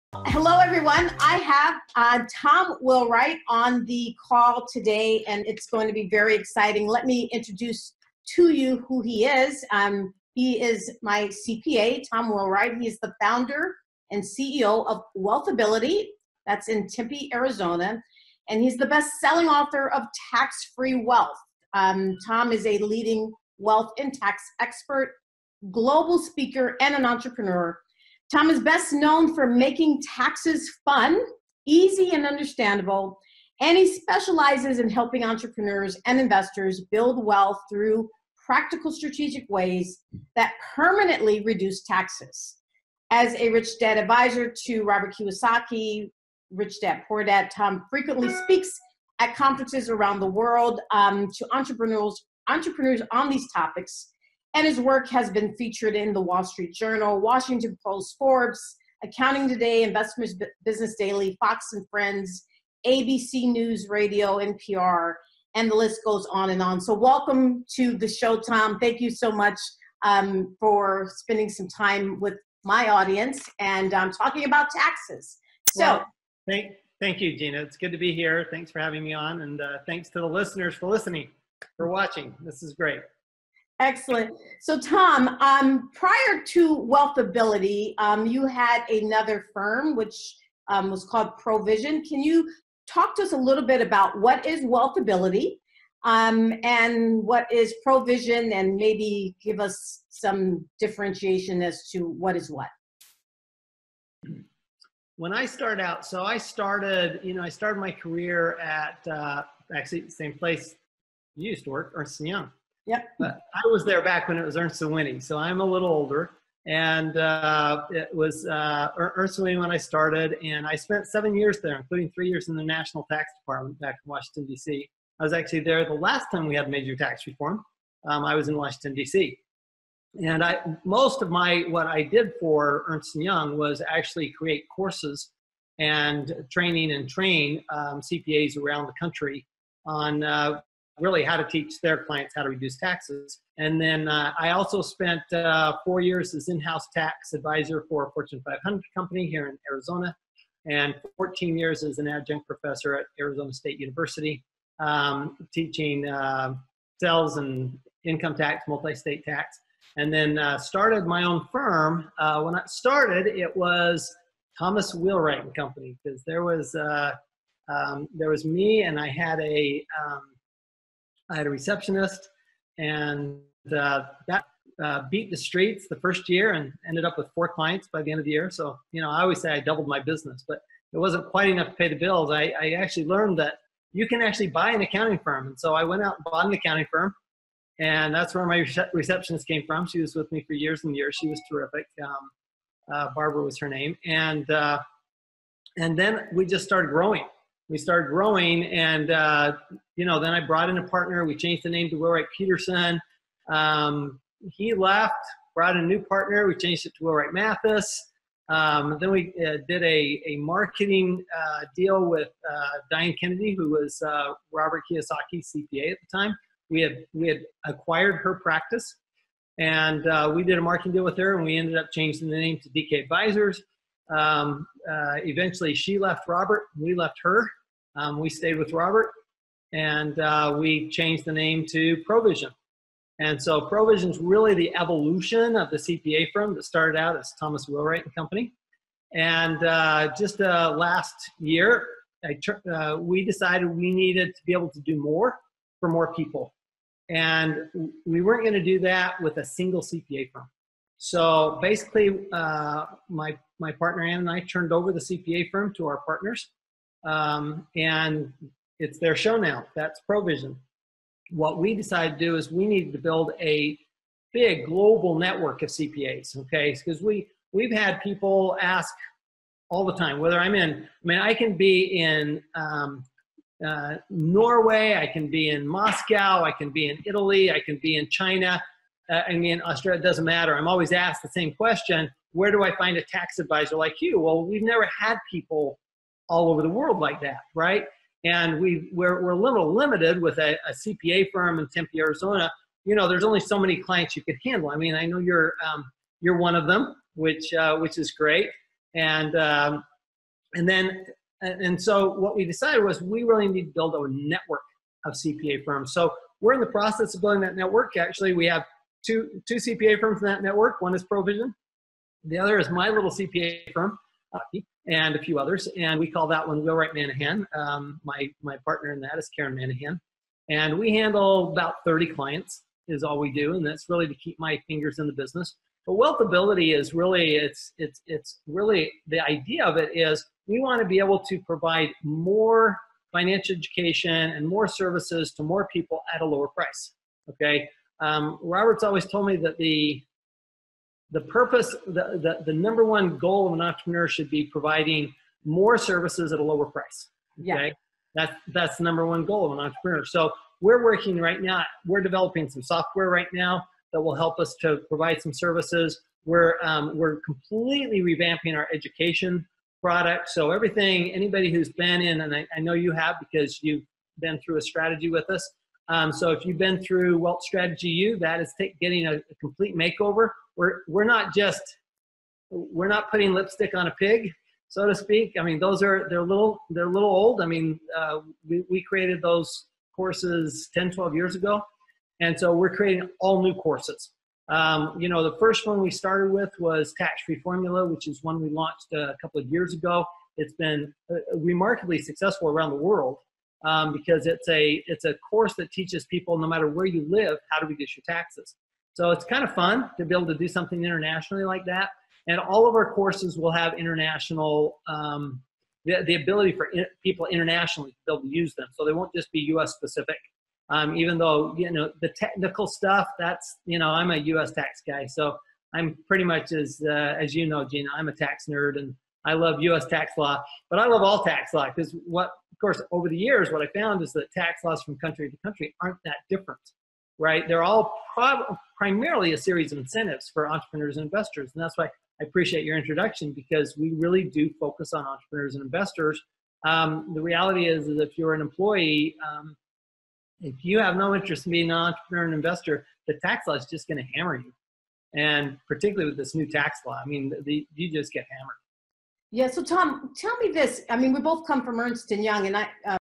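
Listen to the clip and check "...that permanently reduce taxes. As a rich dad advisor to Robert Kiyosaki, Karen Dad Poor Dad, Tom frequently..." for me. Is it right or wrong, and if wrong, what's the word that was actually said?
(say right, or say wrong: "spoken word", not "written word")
wrong: "Rich", not "Karen".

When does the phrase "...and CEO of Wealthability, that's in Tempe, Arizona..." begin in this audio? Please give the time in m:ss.
0:14.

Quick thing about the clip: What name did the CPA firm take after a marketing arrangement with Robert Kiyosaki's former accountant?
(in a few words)
DK Advisors.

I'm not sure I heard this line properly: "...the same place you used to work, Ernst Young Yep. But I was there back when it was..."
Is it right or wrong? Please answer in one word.
right.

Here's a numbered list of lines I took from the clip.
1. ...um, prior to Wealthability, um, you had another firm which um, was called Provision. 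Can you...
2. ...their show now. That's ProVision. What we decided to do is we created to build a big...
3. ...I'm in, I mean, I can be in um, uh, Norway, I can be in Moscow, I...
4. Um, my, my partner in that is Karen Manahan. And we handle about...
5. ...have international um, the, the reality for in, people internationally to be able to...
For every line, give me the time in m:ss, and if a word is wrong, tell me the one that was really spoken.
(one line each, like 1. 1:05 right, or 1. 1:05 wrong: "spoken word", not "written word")
1. 1:25 right
2. 4:18 wrong: "needed", not "created"
3. 4:30 right
4. 5:17 right
5. 6:43 wrong: "ability", not "reality".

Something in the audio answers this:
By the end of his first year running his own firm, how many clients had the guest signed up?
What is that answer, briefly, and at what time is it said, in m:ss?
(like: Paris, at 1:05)
4, at 2:57.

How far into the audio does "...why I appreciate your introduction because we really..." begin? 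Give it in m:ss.
7:11.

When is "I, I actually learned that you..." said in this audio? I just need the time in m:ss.
3:02.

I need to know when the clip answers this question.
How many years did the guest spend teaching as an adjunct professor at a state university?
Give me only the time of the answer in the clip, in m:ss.
2:31.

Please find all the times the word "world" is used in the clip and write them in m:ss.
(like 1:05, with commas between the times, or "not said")
0:50, 4:46, 6:32.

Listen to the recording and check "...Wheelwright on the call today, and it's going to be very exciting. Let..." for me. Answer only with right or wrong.
right.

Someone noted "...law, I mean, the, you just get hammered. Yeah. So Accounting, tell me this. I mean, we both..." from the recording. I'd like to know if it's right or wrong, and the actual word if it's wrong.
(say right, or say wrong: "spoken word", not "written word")
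wrong: "Tom", not "Accounting".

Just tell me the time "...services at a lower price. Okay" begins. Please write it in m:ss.
5:45.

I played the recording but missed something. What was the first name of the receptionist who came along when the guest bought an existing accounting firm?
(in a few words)
Barbara.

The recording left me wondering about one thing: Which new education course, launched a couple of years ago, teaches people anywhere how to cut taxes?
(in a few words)
Tax-Free Formula.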